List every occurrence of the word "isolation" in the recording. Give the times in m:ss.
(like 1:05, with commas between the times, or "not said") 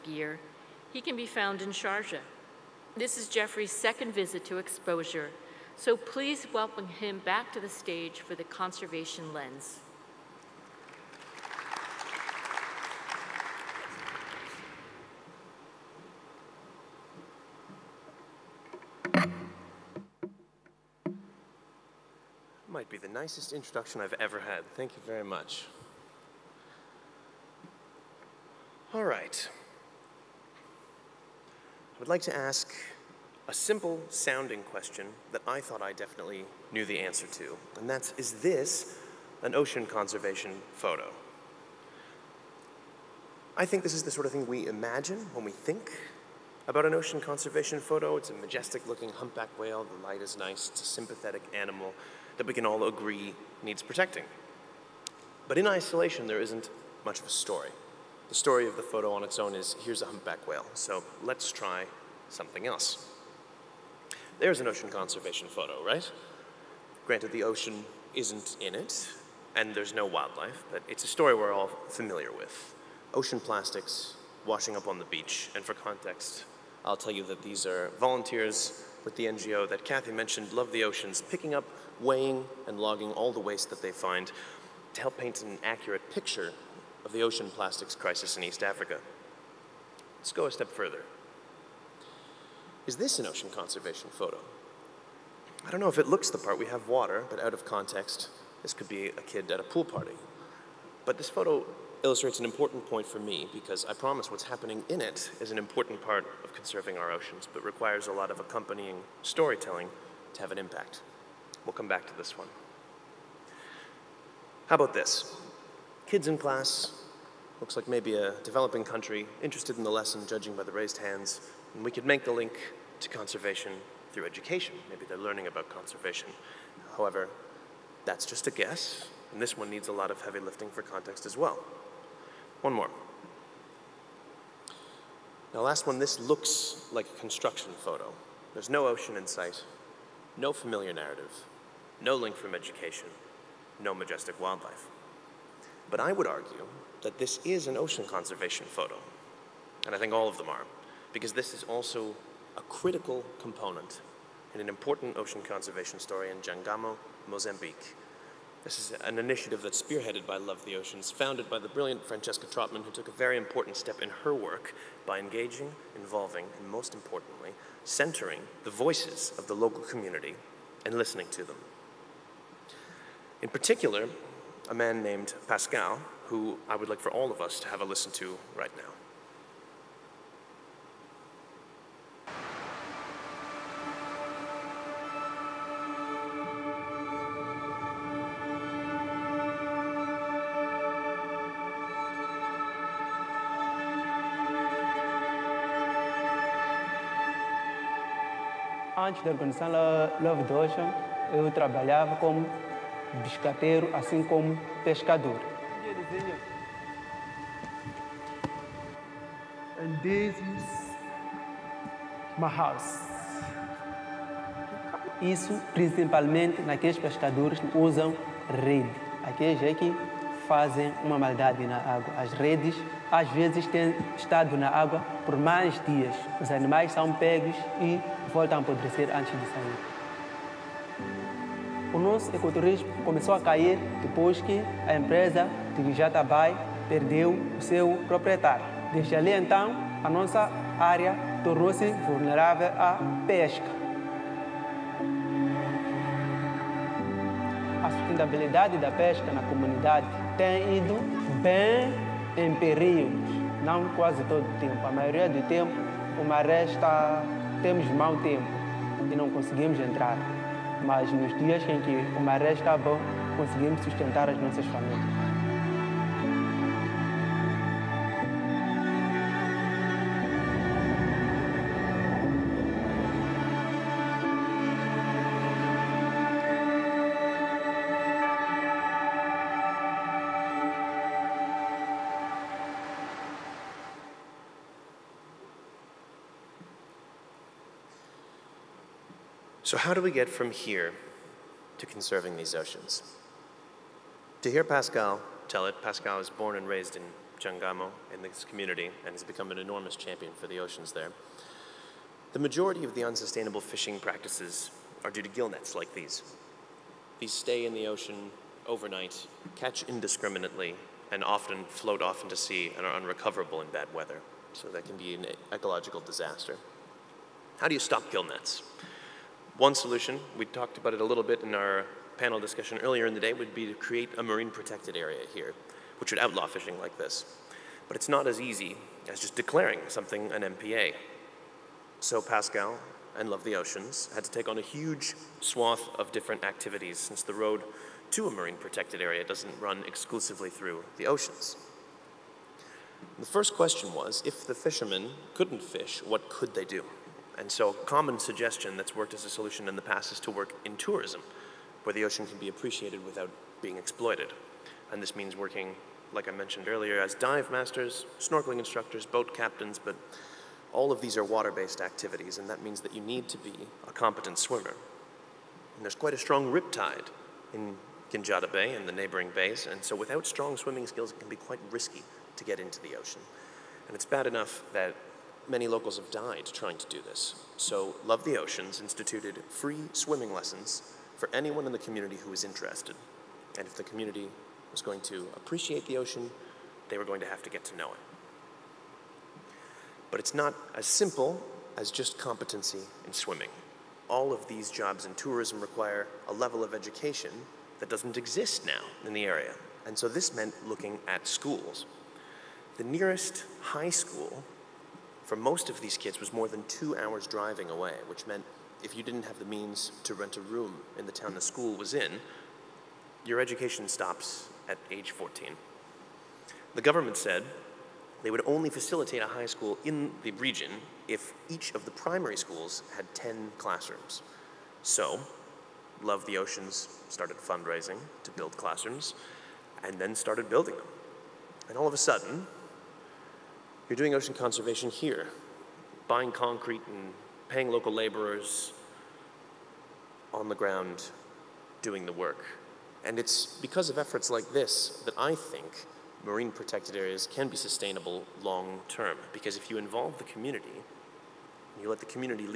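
0:55.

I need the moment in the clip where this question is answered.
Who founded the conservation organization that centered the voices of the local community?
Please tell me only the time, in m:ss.
2:42.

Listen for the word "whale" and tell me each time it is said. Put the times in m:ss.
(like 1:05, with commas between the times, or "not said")
0:49, 1:00.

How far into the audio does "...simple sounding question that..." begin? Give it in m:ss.
0:33.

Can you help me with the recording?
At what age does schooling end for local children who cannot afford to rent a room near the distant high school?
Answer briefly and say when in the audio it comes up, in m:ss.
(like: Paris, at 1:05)
14, at 6:54.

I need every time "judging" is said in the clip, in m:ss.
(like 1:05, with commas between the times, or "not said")
2:00.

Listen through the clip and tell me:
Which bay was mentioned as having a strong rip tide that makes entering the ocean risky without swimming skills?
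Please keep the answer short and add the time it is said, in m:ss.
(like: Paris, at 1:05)
Guinjata Bay, at 6:08.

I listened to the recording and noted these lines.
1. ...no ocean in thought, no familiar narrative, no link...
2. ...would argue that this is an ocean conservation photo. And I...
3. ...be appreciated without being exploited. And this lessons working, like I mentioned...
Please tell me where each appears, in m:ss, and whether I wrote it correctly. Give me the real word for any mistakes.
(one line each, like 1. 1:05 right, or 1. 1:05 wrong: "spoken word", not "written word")
1. 2:18 wrong: "sight", not "thought"
2. 2:26 right
3. 5:52 wrong: "means", not "lessons".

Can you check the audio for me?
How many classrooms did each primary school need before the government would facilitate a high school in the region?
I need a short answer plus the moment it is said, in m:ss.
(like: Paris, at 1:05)
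10, at 7:03.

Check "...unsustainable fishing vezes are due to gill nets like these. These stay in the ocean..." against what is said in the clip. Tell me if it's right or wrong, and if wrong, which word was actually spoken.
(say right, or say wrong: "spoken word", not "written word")
wrong: "practices", not "vezes".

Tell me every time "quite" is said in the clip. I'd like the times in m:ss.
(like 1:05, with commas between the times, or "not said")
6:05, 6:11.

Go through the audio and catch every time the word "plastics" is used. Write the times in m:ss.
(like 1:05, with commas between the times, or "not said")
1:13, 1:27.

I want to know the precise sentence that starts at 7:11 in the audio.
And all of a sudden, you're doing ocean conservation here, buying concrete and paying local laborers on the ground doing the work.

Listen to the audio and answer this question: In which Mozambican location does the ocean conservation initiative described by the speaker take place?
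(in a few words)
Jangamo, Mozambique.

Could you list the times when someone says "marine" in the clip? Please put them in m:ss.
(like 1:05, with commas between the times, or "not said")
5:24, 5:38, 7:26.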